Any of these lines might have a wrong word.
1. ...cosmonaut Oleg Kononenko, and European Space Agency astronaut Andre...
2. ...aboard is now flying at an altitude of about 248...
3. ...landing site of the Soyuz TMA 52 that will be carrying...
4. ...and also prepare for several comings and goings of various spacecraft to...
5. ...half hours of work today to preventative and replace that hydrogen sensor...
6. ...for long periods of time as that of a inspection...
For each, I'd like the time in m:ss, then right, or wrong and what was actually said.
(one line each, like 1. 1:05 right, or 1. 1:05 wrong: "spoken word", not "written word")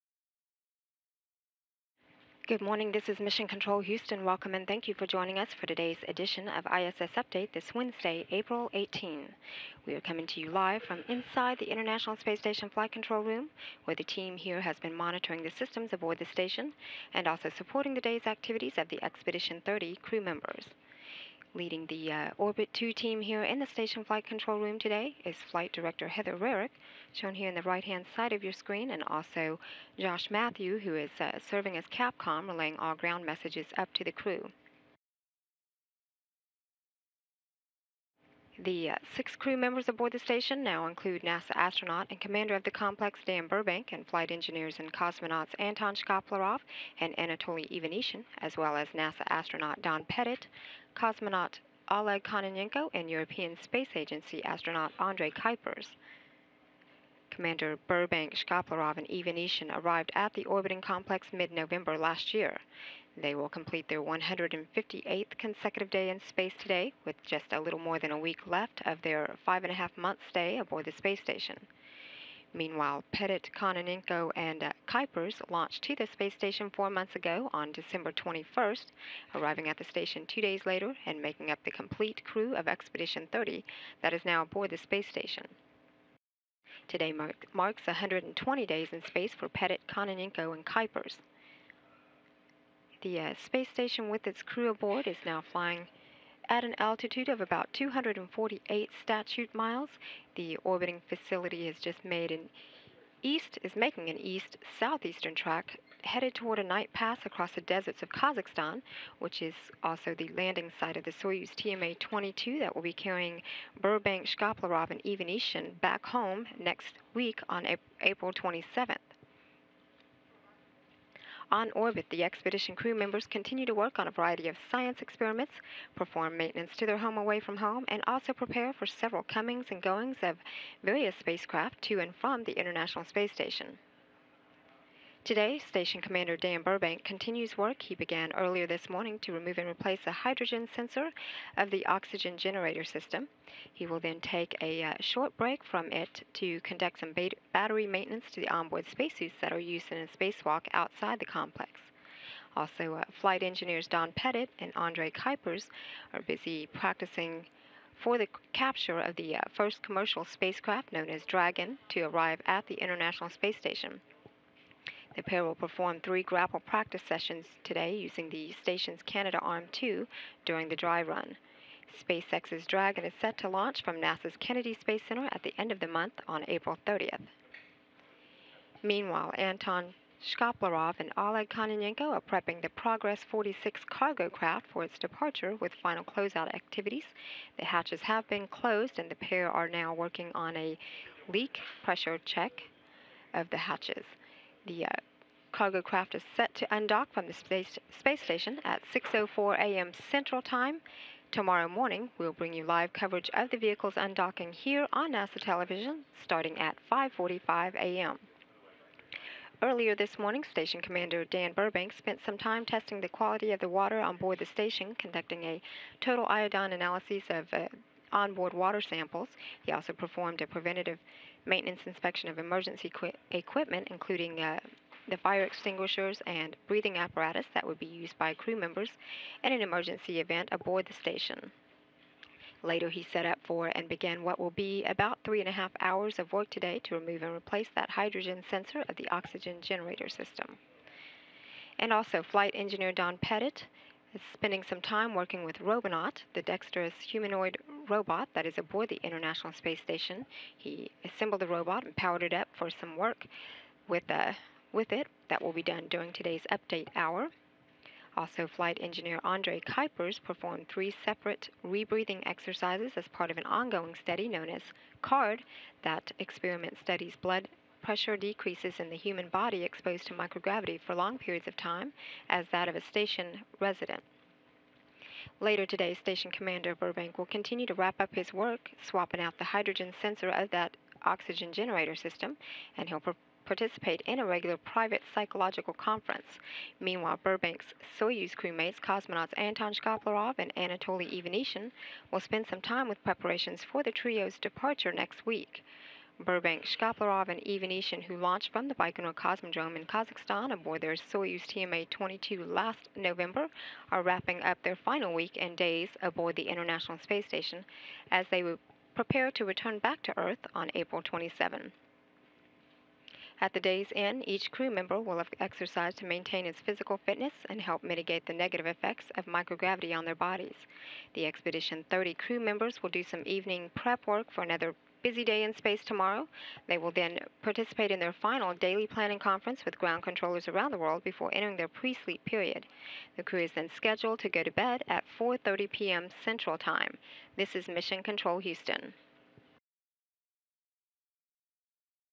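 1. 0:50 right
2. 1:34 right
3. 1:50 wrong: "22", not "52"
4. 2:07 right
5. 3:55 wrong: "remove", not "preventative"
6. 4:30 wrong: "station", not "inspection".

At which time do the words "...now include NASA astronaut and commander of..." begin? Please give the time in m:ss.
0:40.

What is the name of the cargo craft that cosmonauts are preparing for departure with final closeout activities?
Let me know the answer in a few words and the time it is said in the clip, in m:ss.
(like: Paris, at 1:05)
Progress 46, at 3:02.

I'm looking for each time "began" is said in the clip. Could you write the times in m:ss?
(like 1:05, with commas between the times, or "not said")
2:17, 3:53.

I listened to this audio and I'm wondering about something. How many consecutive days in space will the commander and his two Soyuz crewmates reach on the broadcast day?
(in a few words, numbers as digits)
158.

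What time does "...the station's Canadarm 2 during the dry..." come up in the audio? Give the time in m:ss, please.
2:48.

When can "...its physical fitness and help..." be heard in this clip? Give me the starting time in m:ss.
5:16.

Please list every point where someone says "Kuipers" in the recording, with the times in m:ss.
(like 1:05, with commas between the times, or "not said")
0:55, 1:14, 1:30, 2:35, 4:19.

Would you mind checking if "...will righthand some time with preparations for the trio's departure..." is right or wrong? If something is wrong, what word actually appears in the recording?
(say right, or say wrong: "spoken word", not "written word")
wrong: "spend", not "righthand".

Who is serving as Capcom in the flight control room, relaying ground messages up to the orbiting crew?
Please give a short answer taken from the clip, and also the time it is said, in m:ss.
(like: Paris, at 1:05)
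Josh Matthew, at 0:29.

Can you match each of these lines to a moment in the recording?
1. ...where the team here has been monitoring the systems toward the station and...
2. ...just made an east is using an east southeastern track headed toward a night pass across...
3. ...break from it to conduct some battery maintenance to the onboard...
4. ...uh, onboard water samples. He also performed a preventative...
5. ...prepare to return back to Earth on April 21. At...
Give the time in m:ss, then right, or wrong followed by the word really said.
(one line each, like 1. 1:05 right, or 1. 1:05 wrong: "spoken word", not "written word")
1. 0:13 wrong: "aboard", not "toward"
2. 1:41 wrong: "making", not "using"
3. 2:25 right
4. 3:37 right
5. 5:08 wrong: "27", not "21".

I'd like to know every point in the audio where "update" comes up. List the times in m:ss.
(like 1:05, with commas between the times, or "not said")
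0:07, 4:16.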